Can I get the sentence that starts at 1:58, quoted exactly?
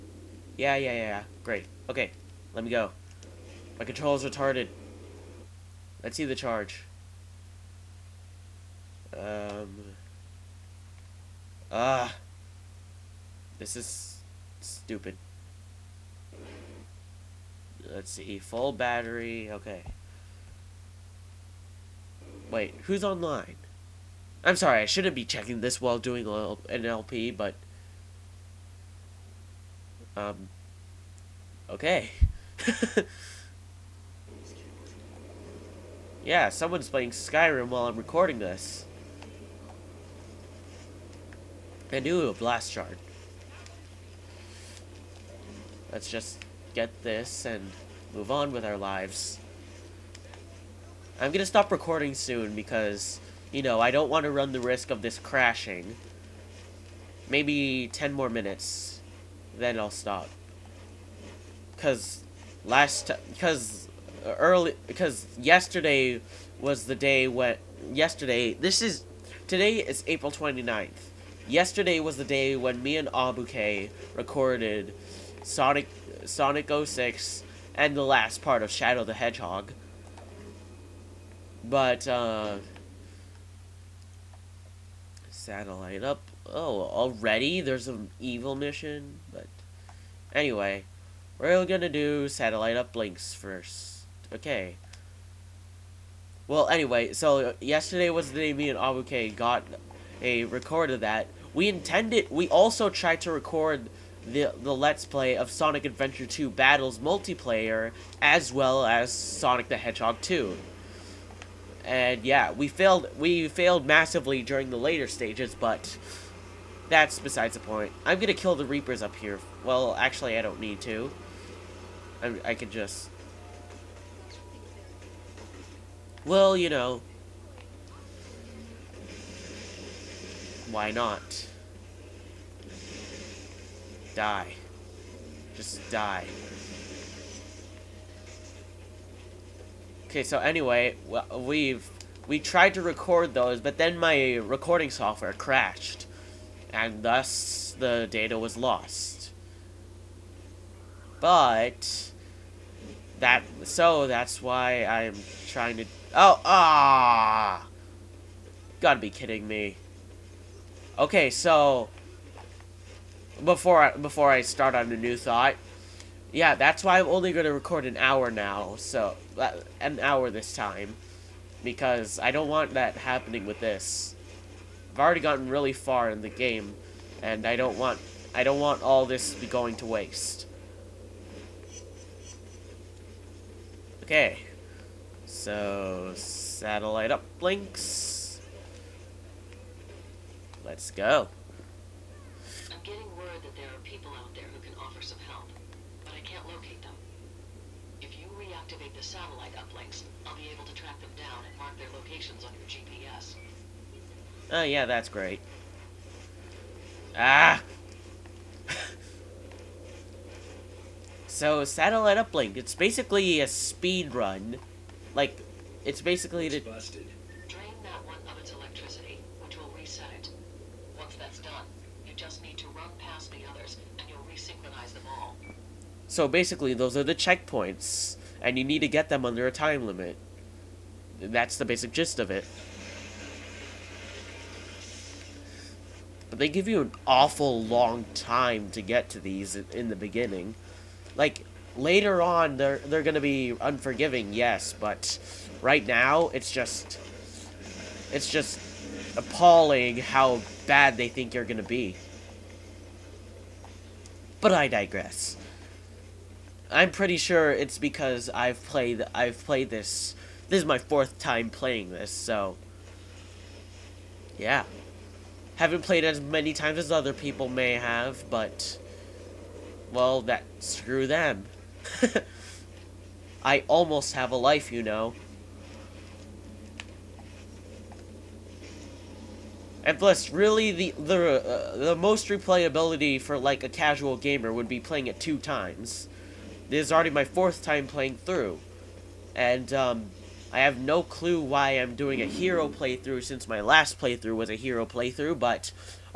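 I'm gonna kill the Reapers up here.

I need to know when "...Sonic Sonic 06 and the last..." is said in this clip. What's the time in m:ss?
1:15.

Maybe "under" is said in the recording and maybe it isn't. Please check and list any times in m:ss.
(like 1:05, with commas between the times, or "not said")
3:49.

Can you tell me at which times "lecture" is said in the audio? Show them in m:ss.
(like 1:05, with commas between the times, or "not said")
not said.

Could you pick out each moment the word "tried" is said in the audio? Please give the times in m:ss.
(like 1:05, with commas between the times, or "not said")
1:42, 2:22.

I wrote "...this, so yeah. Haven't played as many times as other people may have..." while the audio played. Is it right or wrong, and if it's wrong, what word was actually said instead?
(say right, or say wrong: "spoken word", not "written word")
right.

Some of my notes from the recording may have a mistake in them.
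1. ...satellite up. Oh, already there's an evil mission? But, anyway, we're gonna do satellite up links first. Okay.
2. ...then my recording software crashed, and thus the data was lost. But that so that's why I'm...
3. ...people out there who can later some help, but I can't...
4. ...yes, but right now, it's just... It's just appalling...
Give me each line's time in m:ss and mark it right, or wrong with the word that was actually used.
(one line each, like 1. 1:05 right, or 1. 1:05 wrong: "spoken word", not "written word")
1. 1:25 right
2. 2:23 right
3. 3:13 wrong: "offer", not "later"
4. 4:04 right.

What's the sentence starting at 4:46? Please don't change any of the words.
This is already my fourth time playing through.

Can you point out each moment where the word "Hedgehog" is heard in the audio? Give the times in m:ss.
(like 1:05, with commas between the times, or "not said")
1:19, 1:49.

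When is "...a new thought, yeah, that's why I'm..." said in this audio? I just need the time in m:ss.
2:44.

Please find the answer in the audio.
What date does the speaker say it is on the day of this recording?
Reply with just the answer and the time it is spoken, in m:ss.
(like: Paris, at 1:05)
April 29th, at 1:10.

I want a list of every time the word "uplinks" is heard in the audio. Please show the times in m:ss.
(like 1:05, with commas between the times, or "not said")
3:07, 3:19, 3:32.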